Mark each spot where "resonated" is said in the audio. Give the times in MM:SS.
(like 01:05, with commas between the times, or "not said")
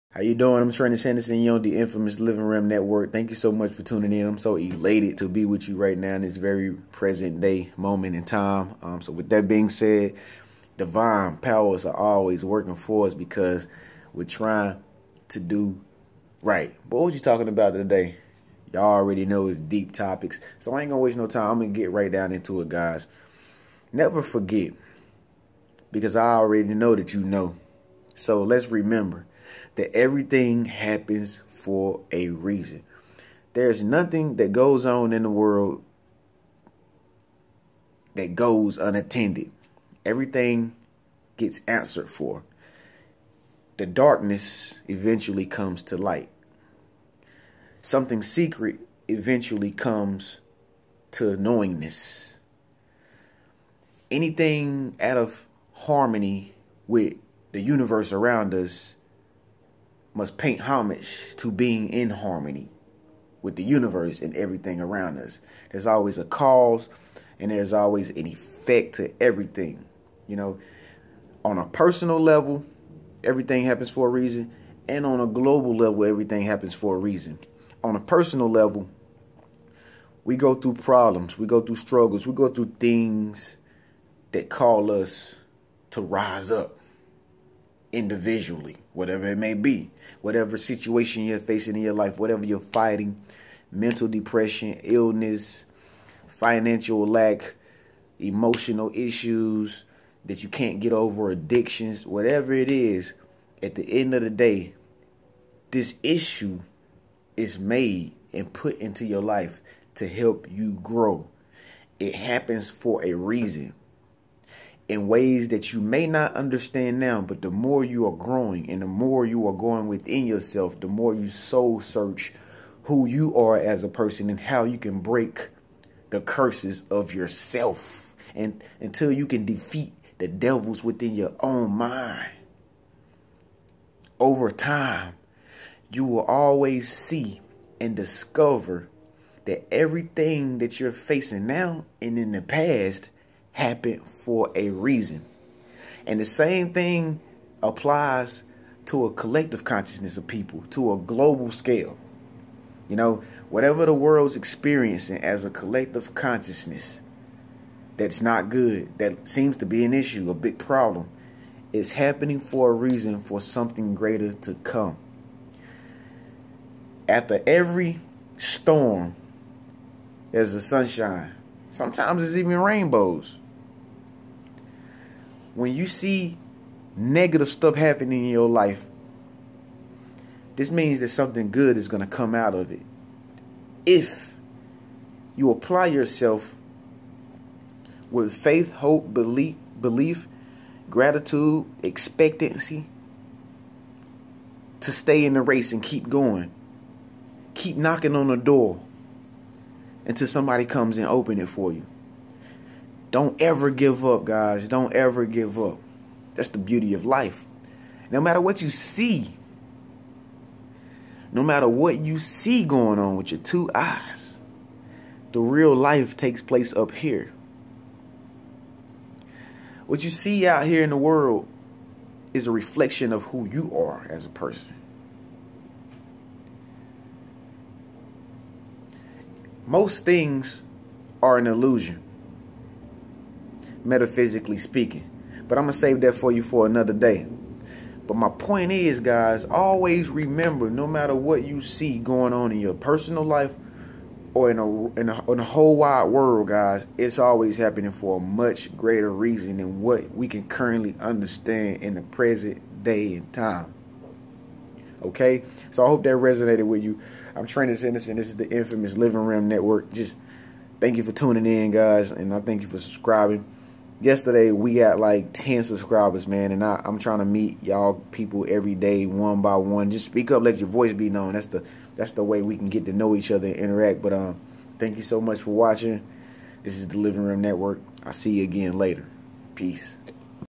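04:16.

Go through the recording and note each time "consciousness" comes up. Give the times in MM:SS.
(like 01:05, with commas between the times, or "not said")
02:29, 02:36.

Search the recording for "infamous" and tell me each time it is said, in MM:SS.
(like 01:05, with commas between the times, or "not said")
00:01, 04:18.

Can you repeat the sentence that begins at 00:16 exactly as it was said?
But what you talking about today?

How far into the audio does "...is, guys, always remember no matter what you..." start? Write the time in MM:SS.
03:58.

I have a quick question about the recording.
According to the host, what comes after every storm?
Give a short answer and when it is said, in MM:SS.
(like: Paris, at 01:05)
sunshine, at 02:50.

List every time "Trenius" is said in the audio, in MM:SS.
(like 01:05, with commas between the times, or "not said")
00:00, 04:17.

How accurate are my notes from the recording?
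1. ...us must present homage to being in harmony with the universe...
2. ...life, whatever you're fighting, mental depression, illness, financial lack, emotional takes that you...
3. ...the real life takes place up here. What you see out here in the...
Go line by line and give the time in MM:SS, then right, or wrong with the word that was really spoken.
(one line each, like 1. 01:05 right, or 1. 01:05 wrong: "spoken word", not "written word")
1. 00:58 wrong: "paint", not "present"
2. 01:31 wrong: "issues", not "takes"
3. 03:35 right.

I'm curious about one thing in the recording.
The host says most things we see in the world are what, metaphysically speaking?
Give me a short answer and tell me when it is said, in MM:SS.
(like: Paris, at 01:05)
an illusion, at 03:51.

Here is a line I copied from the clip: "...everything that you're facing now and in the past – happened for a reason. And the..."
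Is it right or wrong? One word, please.
right.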